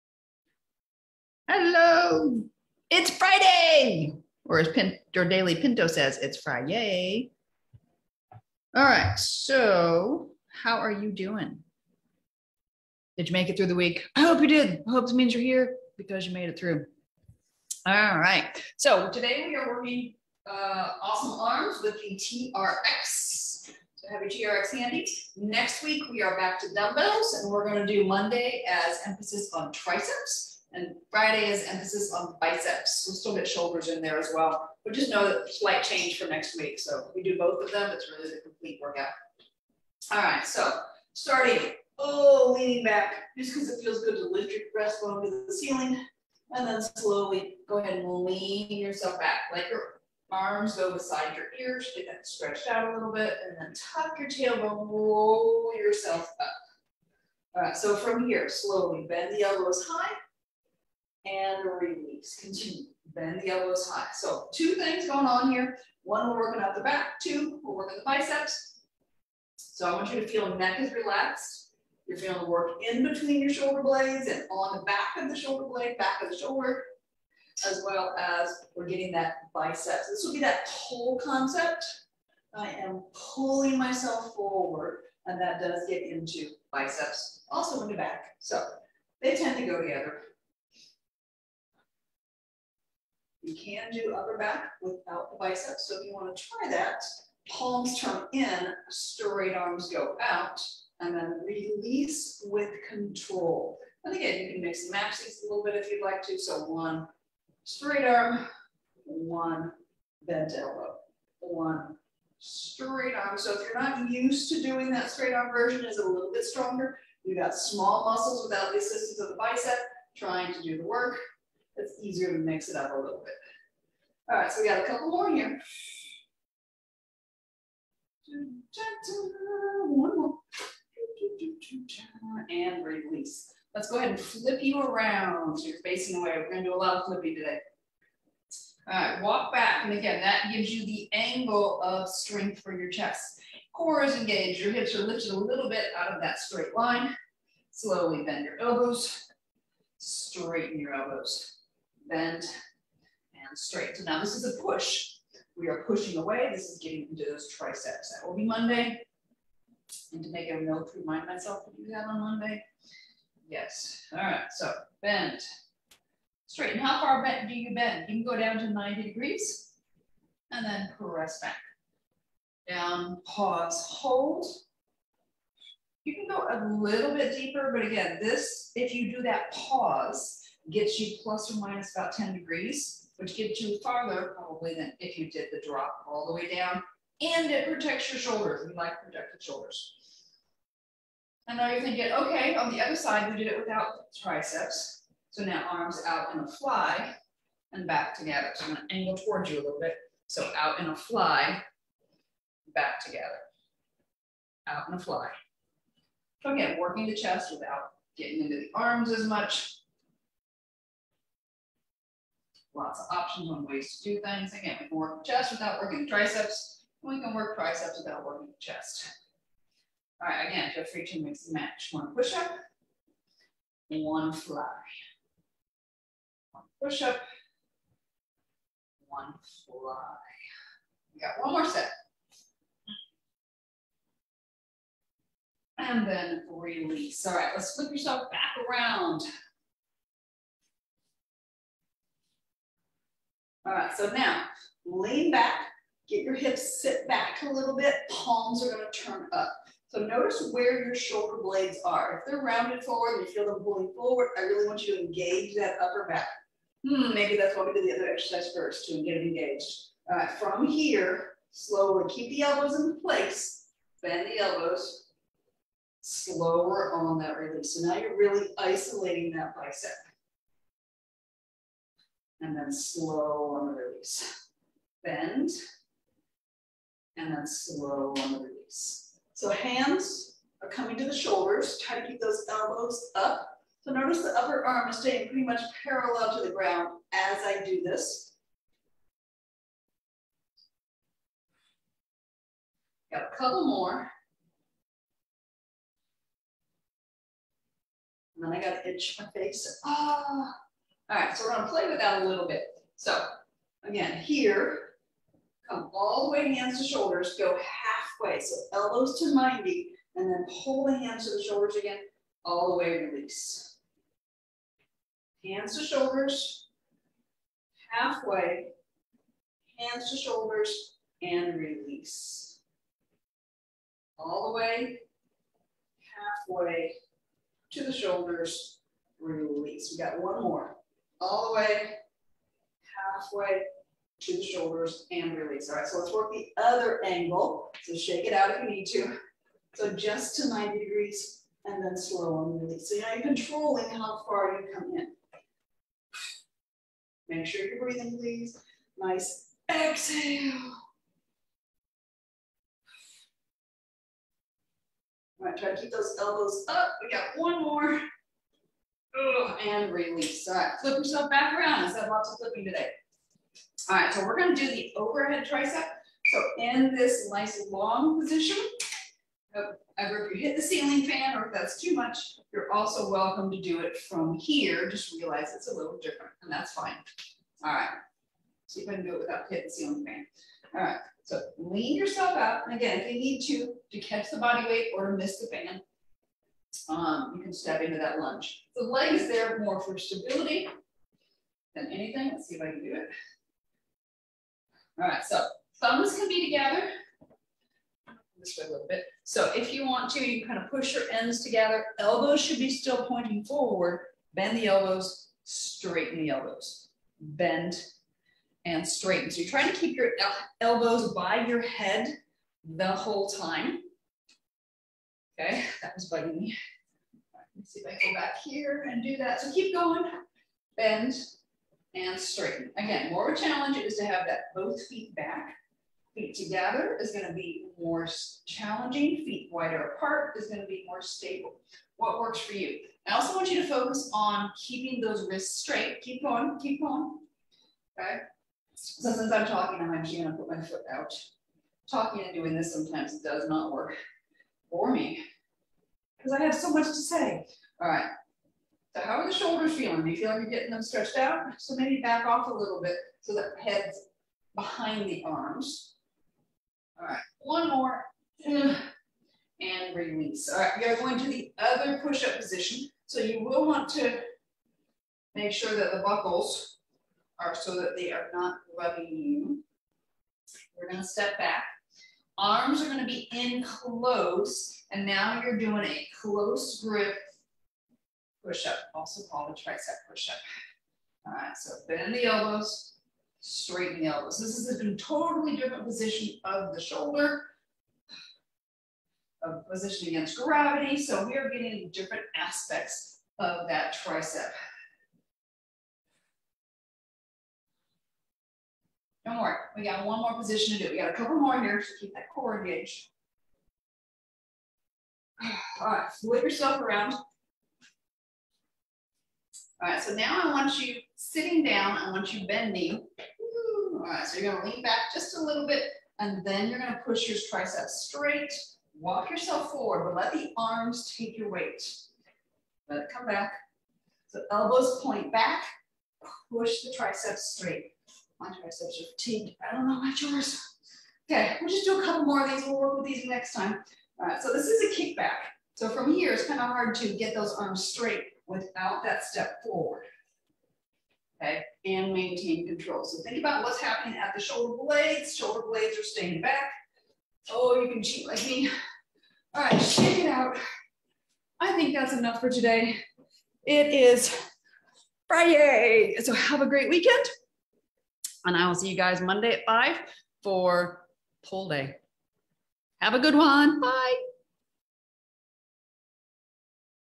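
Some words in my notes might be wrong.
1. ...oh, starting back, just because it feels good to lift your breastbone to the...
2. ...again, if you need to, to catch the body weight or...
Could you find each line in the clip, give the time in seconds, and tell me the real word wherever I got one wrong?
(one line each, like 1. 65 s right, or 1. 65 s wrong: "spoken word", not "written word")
1. 41 s wrong: "leaning", not "starting"
2. 382 s right.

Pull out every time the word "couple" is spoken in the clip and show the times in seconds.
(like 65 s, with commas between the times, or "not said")
124 s, 293 s, 501 s, 532 s.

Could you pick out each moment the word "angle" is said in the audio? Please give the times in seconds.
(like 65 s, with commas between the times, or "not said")
141 s, 198 s, 337 s.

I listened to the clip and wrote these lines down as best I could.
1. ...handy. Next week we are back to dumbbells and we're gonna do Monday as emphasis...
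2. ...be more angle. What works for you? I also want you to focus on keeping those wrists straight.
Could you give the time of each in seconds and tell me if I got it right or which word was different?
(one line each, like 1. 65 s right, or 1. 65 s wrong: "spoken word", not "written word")
1. 24 s right
2. 430 s wrong: "stable", not "angle".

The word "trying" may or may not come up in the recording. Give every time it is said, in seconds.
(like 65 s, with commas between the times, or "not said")
120 s, 409 s.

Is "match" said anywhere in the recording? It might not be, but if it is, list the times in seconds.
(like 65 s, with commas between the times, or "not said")
104 s, 221 s.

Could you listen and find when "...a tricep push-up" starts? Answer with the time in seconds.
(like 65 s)
479 s.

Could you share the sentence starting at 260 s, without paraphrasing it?
All right, from here, slowly keep the elbows in place, bend the elbows, slower on that release.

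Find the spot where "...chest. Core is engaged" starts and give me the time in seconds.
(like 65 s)
142 s.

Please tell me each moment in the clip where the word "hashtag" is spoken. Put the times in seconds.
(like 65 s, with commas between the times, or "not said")
not said.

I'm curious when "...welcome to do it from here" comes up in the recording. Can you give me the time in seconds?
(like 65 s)
373 s.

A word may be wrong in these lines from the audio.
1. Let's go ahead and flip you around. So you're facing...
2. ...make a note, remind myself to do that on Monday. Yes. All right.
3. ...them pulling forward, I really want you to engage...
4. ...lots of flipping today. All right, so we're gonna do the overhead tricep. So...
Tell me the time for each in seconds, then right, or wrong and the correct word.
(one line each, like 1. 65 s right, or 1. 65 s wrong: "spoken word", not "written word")
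1. 133 s right
2. 160 s right
3. 253 s right
4. 362 s right.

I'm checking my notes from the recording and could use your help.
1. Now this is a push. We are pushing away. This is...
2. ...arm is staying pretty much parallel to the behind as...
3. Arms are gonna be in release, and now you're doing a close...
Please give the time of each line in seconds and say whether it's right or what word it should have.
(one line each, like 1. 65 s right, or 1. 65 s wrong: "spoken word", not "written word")
1. 154 s right
2. 284 s wrong: "ground", not "behind"
3. 472 s wrong: "close", not "release".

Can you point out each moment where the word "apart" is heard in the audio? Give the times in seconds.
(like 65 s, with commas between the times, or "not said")
429 s.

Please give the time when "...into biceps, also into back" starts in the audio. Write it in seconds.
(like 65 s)
86 s.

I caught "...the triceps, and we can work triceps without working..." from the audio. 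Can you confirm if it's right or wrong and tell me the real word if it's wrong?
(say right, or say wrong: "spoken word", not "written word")
right.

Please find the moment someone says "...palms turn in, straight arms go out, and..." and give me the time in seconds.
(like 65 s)
97 s.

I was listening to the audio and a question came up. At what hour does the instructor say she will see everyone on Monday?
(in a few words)
5.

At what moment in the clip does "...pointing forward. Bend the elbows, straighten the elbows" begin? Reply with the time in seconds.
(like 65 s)
403 s.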